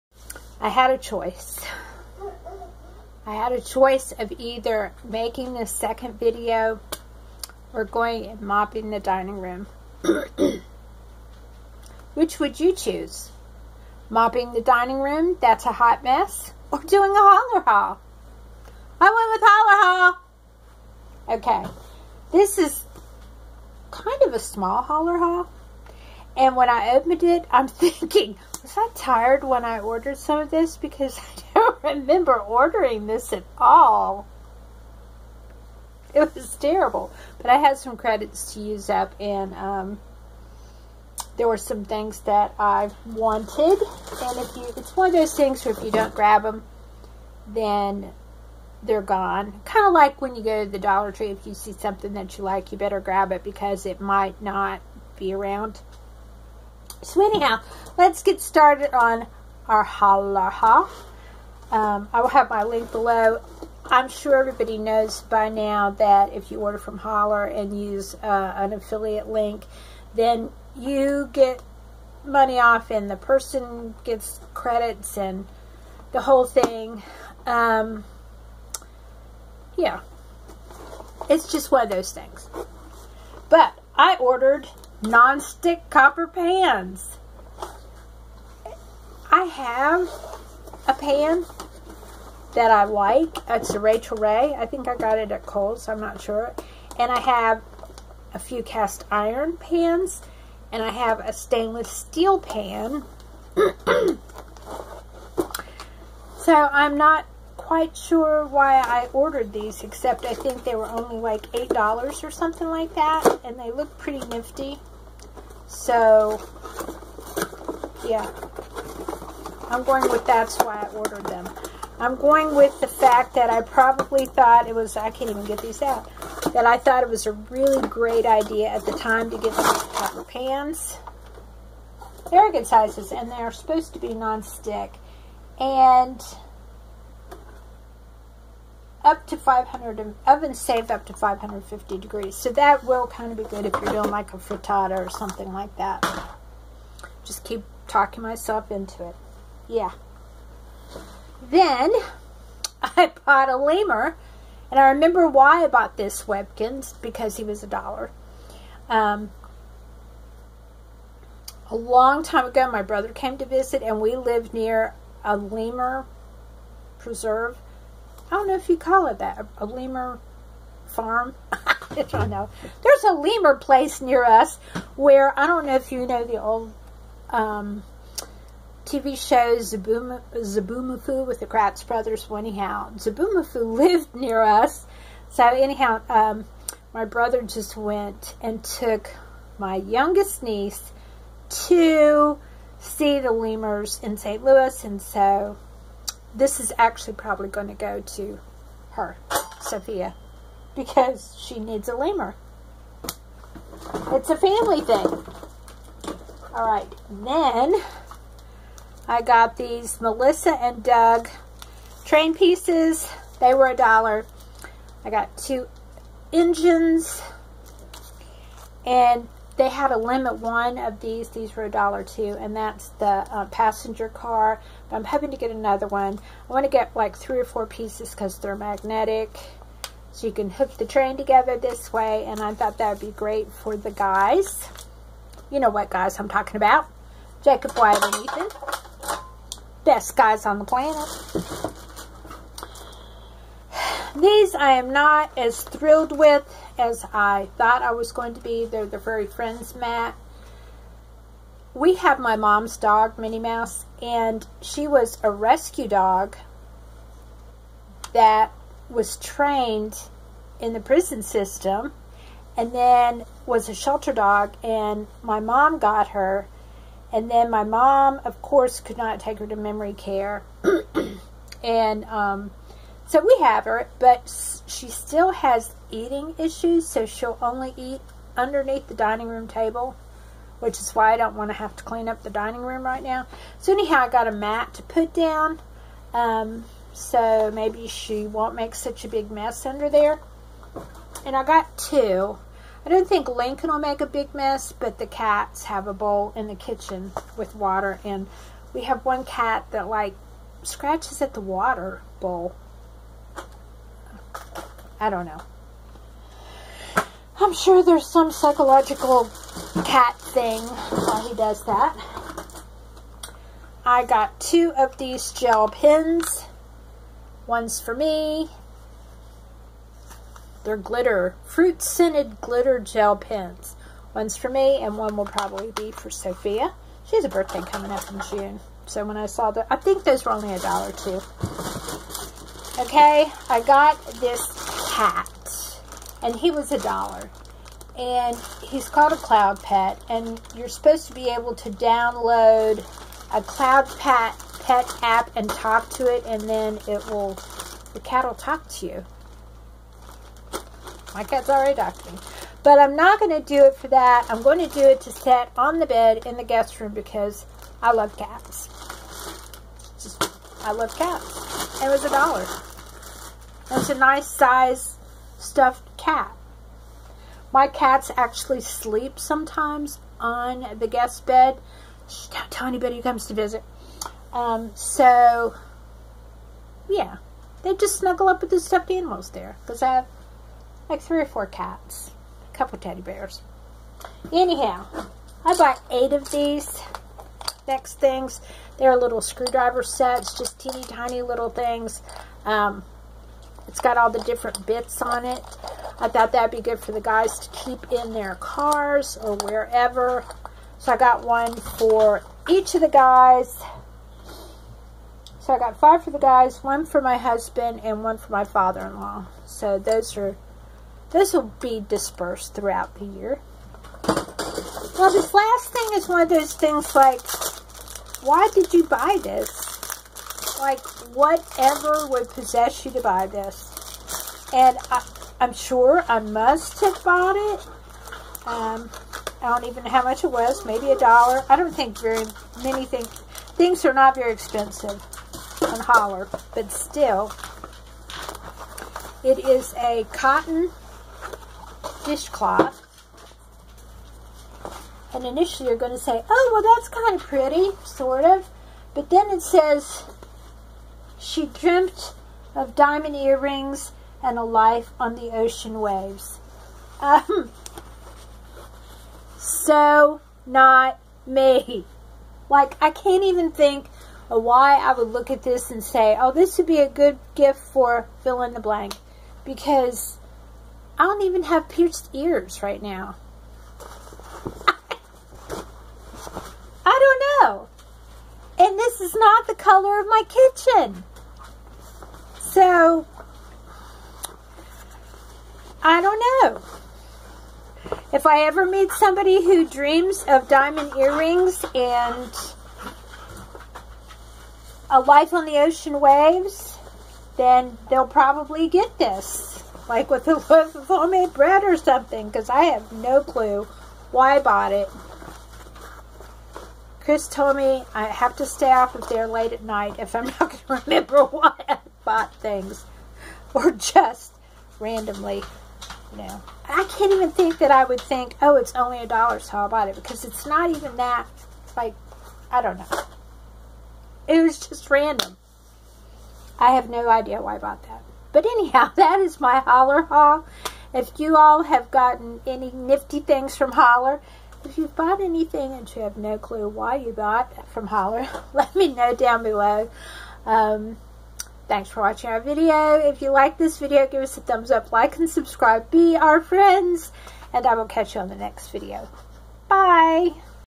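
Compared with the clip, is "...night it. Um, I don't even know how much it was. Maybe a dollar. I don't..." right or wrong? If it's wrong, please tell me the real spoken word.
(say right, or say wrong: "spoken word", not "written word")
wrong: "bought", not "night".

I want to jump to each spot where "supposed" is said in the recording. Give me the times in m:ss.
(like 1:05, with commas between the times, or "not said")
2:13, 5:40.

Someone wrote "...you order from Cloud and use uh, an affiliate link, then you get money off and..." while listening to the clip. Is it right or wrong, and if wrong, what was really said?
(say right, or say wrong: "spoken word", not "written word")
wrong: "Hollar", not "Cloud".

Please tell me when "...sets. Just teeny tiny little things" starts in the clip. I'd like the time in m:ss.
6:29.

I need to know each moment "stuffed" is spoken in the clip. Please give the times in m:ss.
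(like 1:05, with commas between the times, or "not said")
6:05, 6:18.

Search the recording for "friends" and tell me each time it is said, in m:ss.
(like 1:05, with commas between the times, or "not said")
4:09, 9:06.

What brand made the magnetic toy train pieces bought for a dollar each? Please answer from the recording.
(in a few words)
Melissa and Doug.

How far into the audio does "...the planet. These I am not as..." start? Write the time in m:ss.
4:00.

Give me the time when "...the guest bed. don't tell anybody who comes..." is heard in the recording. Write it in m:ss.
6:10.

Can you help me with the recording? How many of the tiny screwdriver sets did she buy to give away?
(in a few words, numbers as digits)
8.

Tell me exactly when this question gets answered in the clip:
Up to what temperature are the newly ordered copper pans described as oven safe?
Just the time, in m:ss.
2:21.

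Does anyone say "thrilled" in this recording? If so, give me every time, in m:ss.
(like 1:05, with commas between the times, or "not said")
4:05.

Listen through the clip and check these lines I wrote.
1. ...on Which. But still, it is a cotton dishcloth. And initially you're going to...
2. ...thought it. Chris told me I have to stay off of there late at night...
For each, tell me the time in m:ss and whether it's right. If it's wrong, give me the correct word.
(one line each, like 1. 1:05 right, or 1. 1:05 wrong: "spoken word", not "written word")
1. 7:15 wrong: "Hollar", not "Which"
2. 8:24 wrong: "bought", not "thought".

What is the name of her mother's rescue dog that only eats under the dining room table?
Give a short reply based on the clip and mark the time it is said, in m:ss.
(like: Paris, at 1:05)
Minnie Mouse, at 4:13.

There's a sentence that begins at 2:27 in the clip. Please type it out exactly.
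Just keep talking myself into it.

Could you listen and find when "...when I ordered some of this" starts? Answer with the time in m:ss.
0:29.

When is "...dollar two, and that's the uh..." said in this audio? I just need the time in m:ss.
3:41.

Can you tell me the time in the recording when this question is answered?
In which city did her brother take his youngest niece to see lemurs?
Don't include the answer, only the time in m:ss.
3:14.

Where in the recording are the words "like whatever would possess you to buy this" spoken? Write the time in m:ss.
7:00.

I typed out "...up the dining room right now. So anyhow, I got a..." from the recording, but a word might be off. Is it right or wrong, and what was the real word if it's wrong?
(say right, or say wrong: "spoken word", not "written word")
right.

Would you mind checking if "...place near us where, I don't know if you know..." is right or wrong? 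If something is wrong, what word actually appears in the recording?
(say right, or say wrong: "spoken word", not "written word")
right.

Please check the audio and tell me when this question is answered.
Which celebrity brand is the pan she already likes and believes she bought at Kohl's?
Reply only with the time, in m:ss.
1:33.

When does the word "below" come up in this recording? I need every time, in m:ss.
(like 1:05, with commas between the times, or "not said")
1:02, 8:59.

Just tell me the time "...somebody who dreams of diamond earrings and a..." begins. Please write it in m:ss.
8:08.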